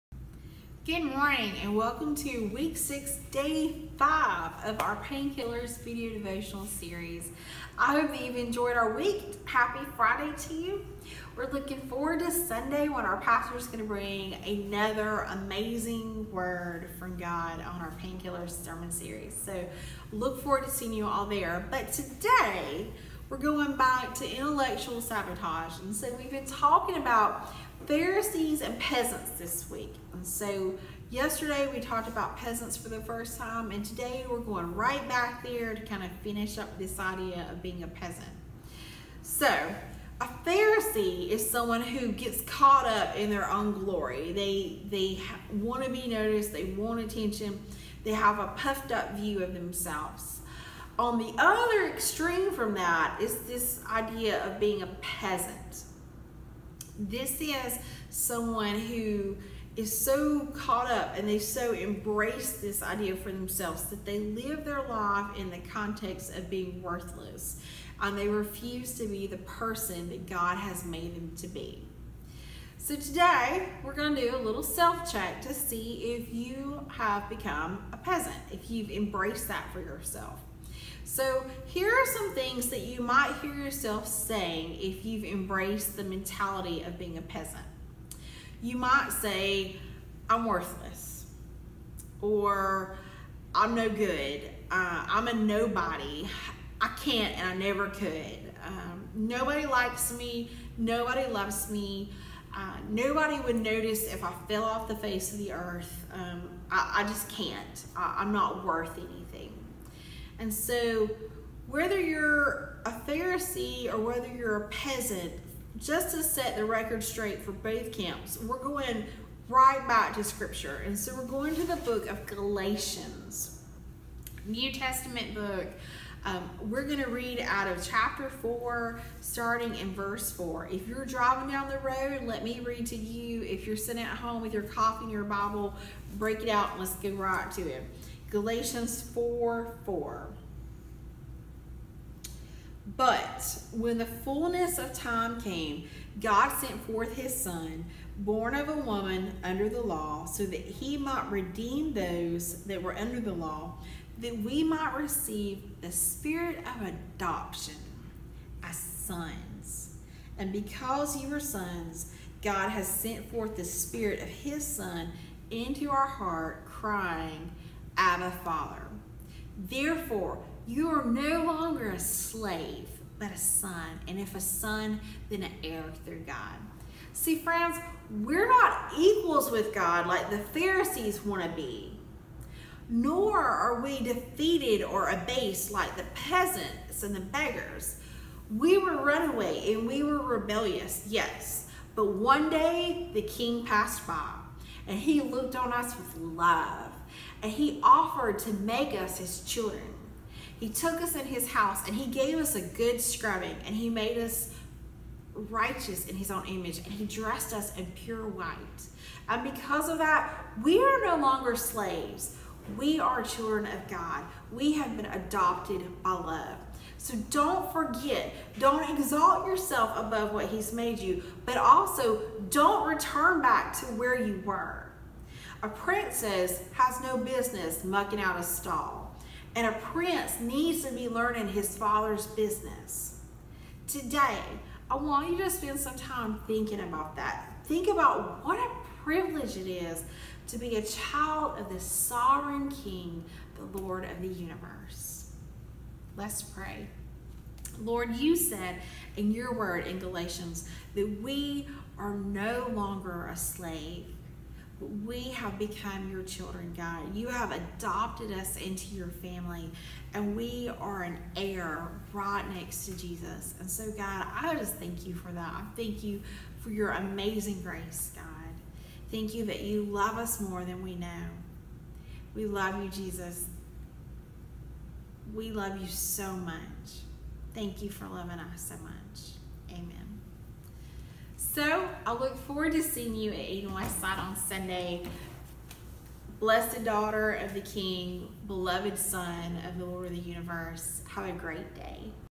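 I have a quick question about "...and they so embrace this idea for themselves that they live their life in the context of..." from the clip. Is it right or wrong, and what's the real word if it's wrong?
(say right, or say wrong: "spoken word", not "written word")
right.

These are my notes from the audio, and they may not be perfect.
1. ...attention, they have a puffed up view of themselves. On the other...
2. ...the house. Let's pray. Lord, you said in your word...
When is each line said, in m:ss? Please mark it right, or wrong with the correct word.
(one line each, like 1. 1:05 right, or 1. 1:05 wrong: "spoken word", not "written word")
1. 0:46 right
2. 4:04 wrong: "universe", not "house".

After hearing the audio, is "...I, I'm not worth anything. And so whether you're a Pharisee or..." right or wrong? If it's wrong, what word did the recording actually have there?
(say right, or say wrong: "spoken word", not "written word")
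right.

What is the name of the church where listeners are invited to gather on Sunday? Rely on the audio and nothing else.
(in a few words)
Eden Westside.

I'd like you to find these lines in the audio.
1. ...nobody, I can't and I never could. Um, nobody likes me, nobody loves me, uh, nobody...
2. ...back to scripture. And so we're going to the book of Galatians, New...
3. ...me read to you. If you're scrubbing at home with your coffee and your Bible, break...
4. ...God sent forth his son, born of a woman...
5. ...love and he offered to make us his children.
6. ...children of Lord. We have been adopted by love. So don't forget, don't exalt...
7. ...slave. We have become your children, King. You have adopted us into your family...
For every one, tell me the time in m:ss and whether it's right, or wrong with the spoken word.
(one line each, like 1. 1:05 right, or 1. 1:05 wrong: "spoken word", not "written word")
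1. 1:35 right
2. 1:59 right
3. 2:12 wrong: "sitting", not "scrubbing"
4. 2:26 right
5. 3:16 right
6. 3:33 wrong: "God", not "Lord"
7. 4:13 wrong: "God", not "King".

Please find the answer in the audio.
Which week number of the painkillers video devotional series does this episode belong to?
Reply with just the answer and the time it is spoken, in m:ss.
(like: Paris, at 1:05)
6, at 0:02.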